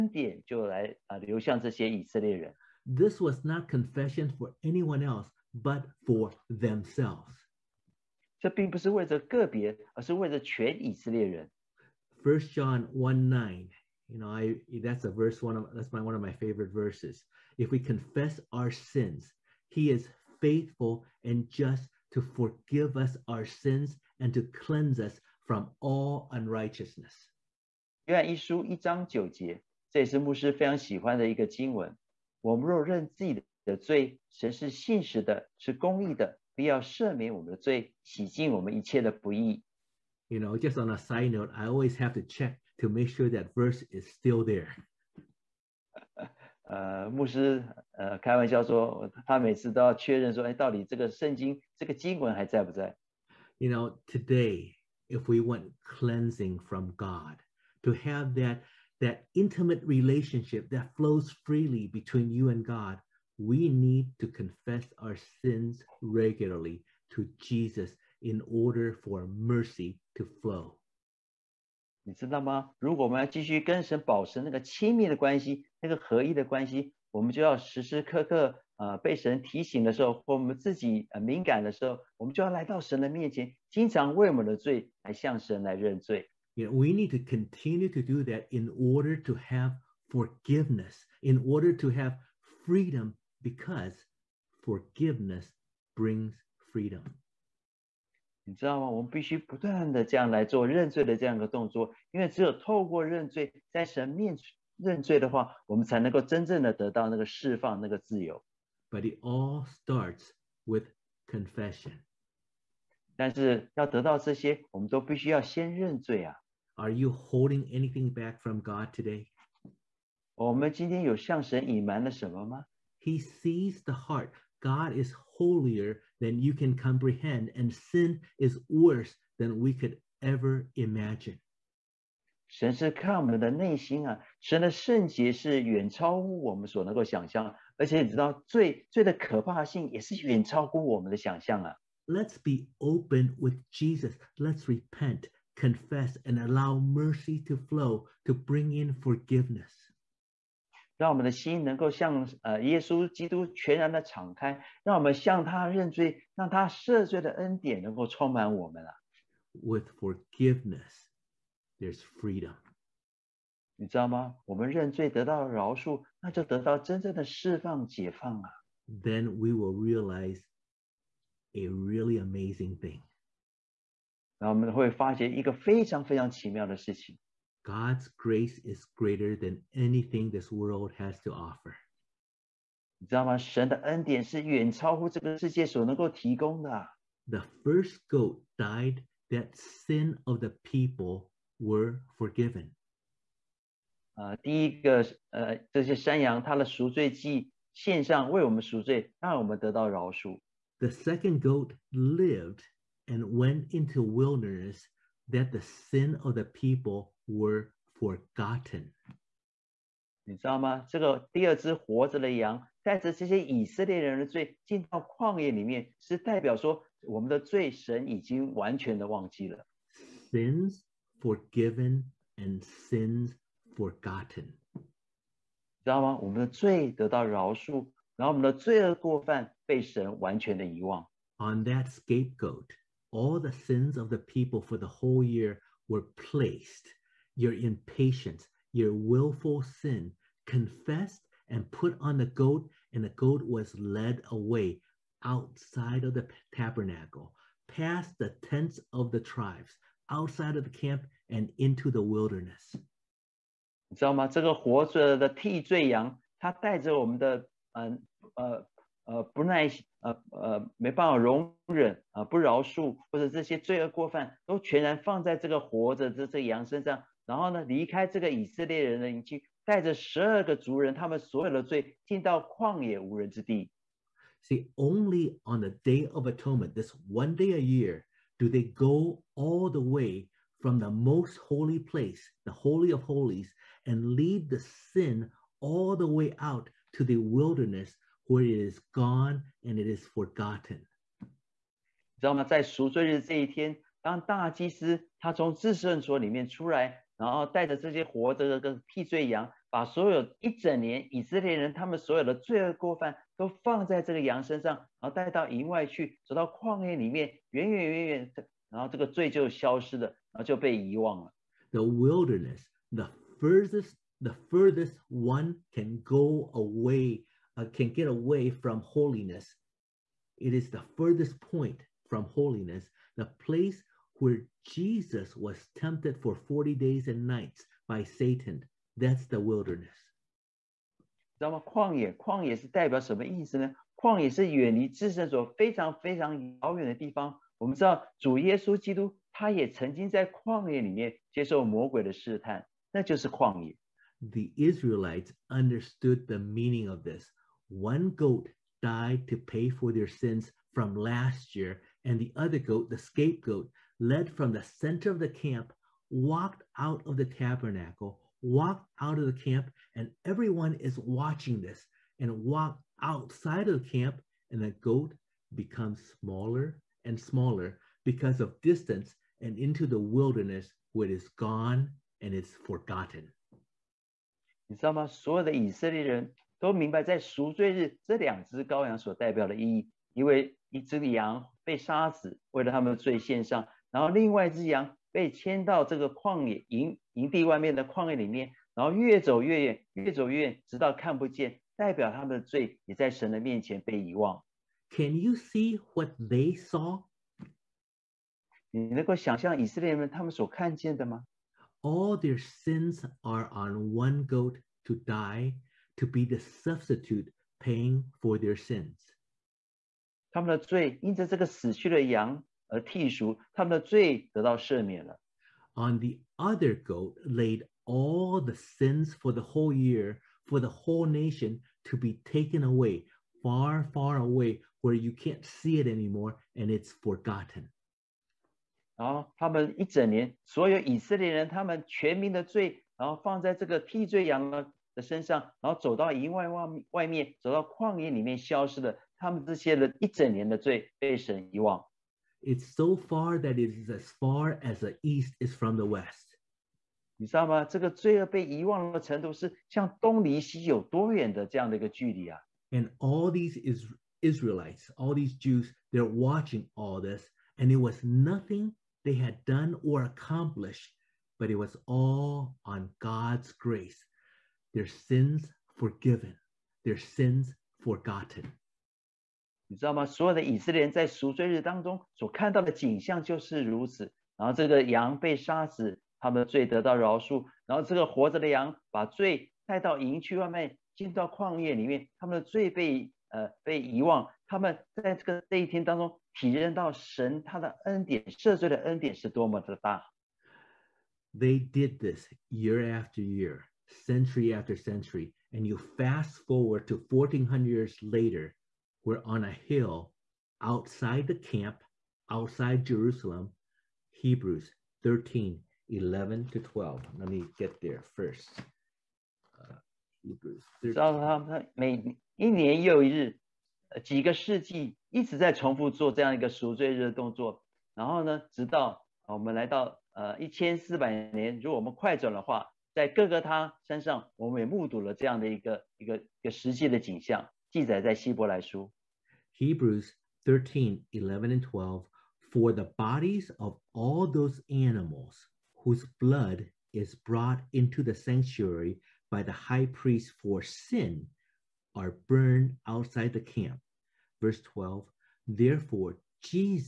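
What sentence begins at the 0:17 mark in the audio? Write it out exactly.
If we confess our sins, He is faithful and just to forgive us our sins and to cleanse us from all unrighteousness.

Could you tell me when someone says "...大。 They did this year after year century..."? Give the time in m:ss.
8:09.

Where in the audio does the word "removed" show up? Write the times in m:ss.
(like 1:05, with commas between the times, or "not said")
not said.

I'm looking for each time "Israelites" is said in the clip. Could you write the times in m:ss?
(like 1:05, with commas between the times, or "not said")
5:44, 7:34.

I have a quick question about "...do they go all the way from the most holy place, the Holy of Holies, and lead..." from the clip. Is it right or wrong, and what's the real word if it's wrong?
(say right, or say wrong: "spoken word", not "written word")
right.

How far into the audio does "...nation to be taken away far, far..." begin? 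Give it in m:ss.
7:01.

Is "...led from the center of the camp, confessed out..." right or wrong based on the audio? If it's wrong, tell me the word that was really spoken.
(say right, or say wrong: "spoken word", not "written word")
wrong: "walked", not "confessed".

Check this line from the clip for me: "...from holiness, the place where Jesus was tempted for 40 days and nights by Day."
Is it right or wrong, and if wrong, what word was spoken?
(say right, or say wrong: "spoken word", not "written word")
wrong: "Satan", not "Day".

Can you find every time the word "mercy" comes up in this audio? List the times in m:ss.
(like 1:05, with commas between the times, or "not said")
1:09, 2:26.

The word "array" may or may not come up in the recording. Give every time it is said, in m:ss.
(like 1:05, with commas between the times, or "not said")
not said.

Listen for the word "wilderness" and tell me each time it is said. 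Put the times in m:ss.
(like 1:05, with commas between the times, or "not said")
3:24, 4:12, 4:47, 5:11, 5:29, 6:09.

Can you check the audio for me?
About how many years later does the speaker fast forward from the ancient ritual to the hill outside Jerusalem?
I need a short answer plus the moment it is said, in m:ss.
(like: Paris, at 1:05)
1400, at 8:17.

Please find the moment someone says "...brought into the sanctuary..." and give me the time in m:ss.
8:57.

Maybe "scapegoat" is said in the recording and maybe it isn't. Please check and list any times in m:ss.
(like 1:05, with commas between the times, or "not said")
3:51, 5:52.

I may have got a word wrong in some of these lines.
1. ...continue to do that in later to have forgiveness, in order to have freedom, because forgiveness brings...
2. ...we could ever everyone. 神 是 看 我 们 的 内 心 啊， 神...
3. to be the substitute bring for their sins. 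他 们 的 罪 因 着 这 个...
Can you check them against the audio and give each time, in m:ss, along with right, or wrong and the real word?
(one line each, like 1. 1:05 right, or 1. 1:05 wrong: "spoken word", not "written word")
1. 1:27 wrong: "order", not "later"
2. 2:09 wrong: "imagine", not "everyone"
3. 6:45 wrong: "paying", not "bring".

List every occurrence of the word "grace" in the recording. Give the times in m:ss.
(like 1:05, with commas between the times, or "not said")
2:58, 7:43.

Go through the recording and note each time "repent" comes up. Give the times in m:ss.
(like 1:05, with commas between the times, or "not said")
2:24.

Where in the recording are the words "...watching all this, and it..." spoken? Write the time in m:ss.
7:36.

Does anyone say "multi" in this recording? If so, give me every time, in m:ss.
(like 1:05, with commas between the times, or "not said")
not said.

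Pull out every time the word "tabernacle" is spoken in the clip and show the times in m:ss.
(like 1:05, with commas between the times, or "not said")
4:06, 5:57.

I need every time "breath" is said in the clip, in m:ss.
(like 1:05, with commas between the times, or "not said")
not said.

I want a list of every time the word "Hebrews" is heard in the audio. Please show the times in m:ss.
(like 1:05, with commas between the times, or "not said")
8:24, 8:30, 8:49.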